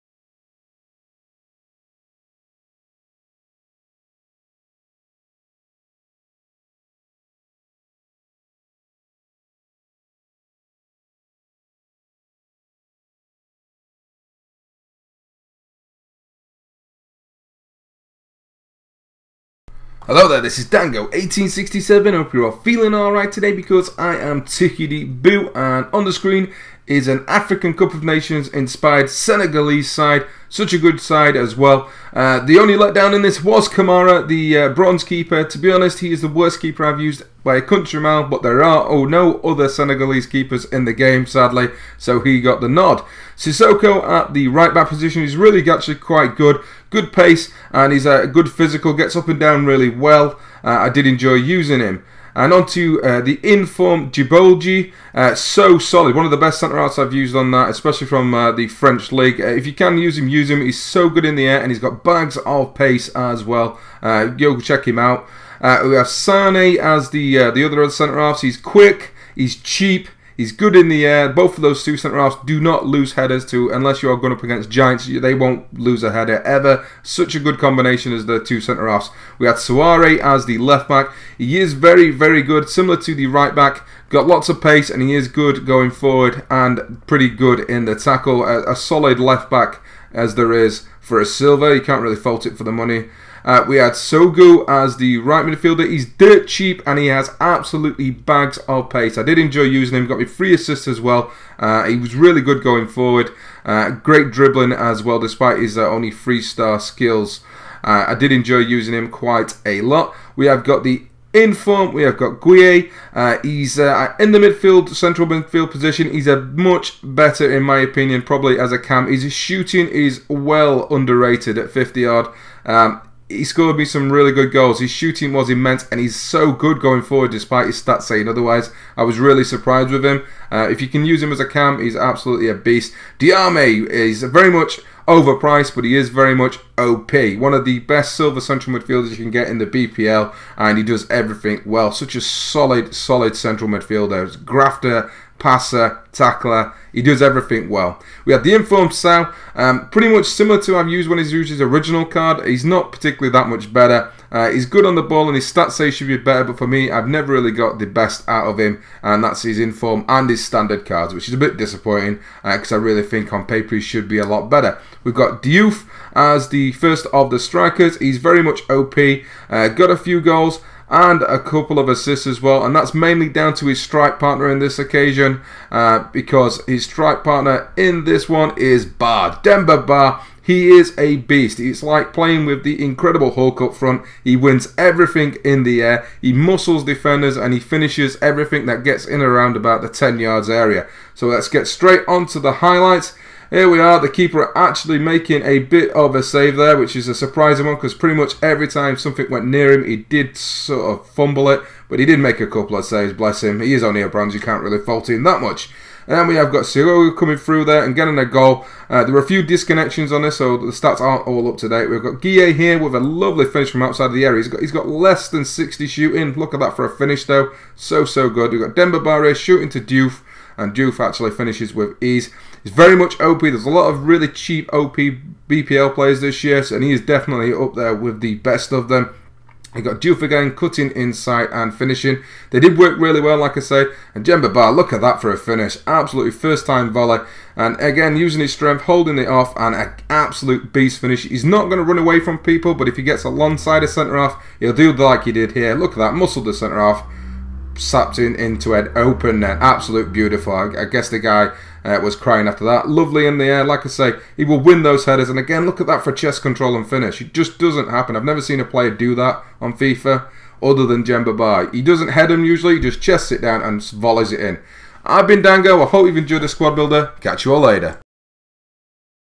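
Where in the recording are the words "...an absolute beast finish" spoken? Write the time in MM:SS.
03:59.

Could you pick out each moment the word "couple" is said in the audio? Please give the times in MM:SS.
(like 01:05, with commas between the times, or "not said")
02:51, 03:22.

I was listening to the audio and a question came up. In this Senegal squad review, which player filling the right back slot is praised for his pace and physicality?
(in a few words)
Sissoko.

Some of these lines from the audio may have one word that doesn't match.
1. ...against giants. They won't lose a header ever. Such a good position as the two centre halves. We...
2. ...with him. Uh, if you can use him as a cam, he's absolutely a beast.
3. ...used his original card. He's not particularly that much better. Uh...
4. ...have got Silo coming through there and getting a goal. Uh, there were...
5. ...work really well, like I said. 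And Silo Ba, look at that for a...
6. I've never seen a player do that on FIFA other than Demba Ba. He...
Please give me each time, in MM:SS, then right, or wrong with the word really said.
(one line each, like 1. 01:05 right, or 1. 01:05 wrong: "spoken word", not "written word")
1. 01:14 wrong: "combination", not "position"
2. 02:09 right
3. 02:31 right
4. 03:26 right
5. 03:52 wrong: "Demba", not "Silo"
6. 04:18 right.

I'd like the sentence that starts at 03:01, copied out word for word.
It's like playing with the incredible Hulk up front.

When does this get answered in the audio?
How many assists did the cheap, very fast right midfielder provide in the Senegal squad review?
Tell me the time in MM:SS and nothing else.
01:40.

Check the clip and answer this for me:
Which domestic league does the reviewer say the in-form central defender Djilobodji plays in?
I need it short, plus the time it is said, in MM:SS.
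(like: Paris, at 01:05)
French league, at 00:58.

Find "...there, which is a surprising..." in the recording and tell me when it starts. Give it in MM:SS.
03:16.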